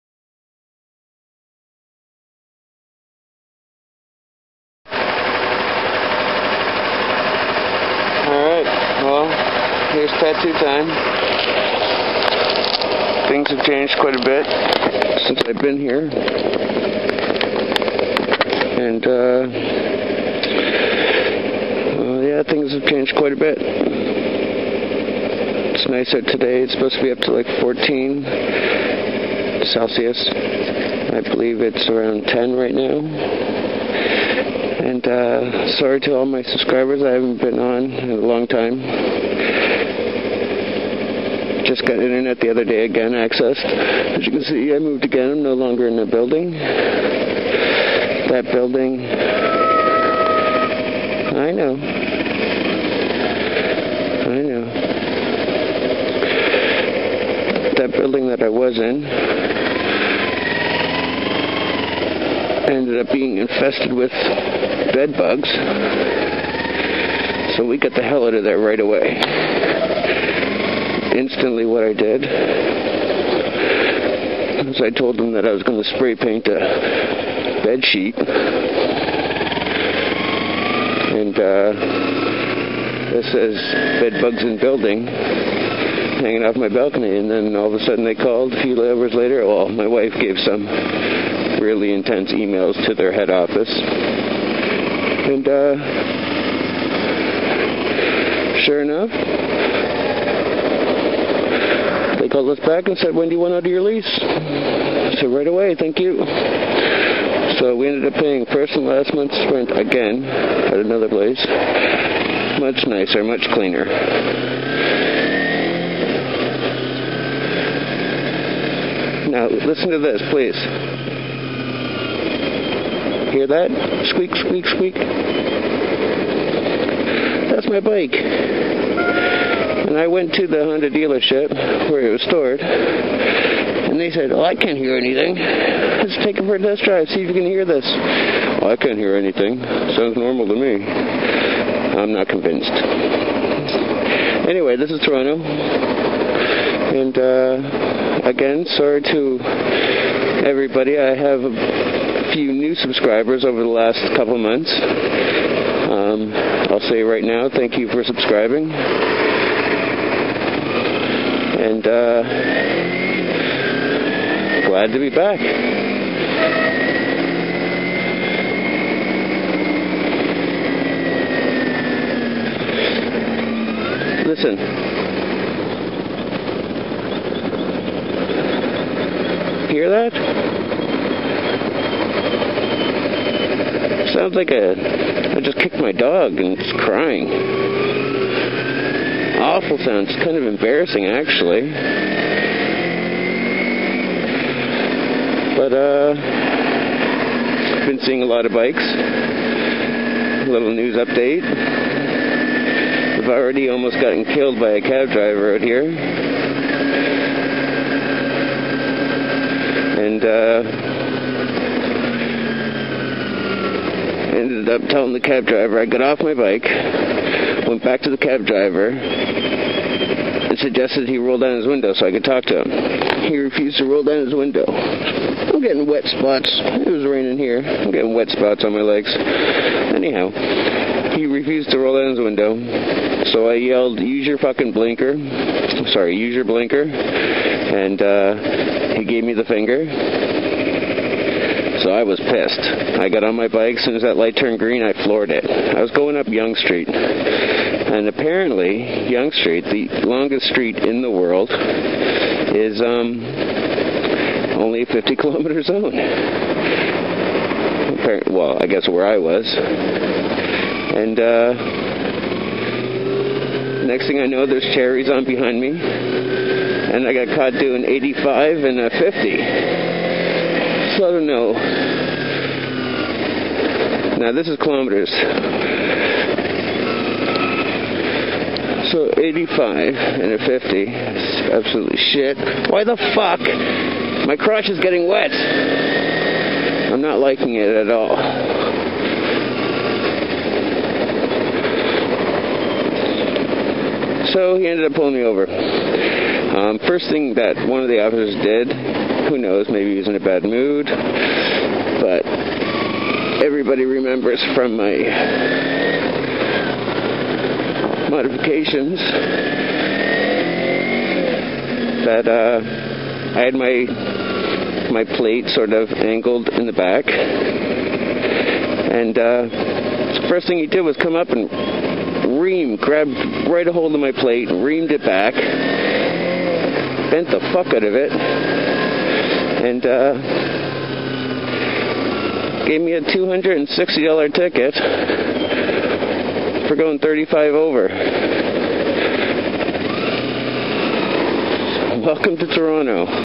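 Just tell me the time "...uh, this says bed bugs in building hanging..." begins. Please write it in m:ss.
1:21.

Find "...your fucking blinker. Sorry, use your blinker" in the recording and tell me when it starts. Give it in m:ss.
3:54.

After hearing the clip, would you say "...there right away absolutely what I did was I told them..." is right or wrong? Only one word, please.
wrong.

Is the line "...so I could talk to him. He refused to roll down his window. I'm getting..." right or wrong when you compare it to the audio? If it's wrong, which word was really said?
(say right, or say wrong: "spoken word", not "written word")
right.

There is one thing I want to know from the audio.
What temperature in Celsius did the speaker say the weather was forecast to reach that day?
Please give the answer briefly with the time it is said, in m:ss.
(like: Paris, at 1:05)
14, at 0:27.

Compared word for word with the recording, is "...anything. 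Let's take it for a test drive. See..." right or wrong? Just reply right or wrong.
right.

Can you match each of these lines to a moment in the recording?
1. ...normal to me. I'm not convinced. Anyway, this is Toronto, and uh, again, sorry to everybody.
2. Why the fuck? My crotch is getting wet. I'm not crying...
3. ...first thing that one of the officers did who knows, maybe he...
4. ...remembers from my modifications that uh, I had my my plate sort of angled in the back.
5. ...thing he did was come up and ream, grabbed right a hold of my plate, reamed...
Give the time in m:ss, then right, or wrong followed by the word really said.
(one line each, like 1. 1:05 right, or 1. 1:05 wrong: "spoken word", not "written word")
1. 2:20 right
2. 4:42 wrong: "liking", not "crying"
3. 4:56 right
4. 5:03 right
5. 5:20 right.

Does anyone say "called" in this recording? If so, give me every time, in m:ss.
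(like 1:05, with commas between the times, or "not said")
1:28, 1:42.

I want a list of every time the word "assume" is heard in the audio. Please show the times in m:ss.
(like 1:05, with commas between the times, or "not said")
not said.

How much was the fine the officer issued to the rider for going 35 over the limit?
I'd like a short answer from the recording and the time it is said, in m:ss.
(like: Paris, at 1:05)
$260, at 5:33.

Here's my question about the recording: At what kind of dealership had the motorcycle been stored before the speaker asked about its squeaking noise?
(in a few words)
Honda.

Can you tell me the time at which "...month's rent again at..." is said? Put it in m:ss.
1:49.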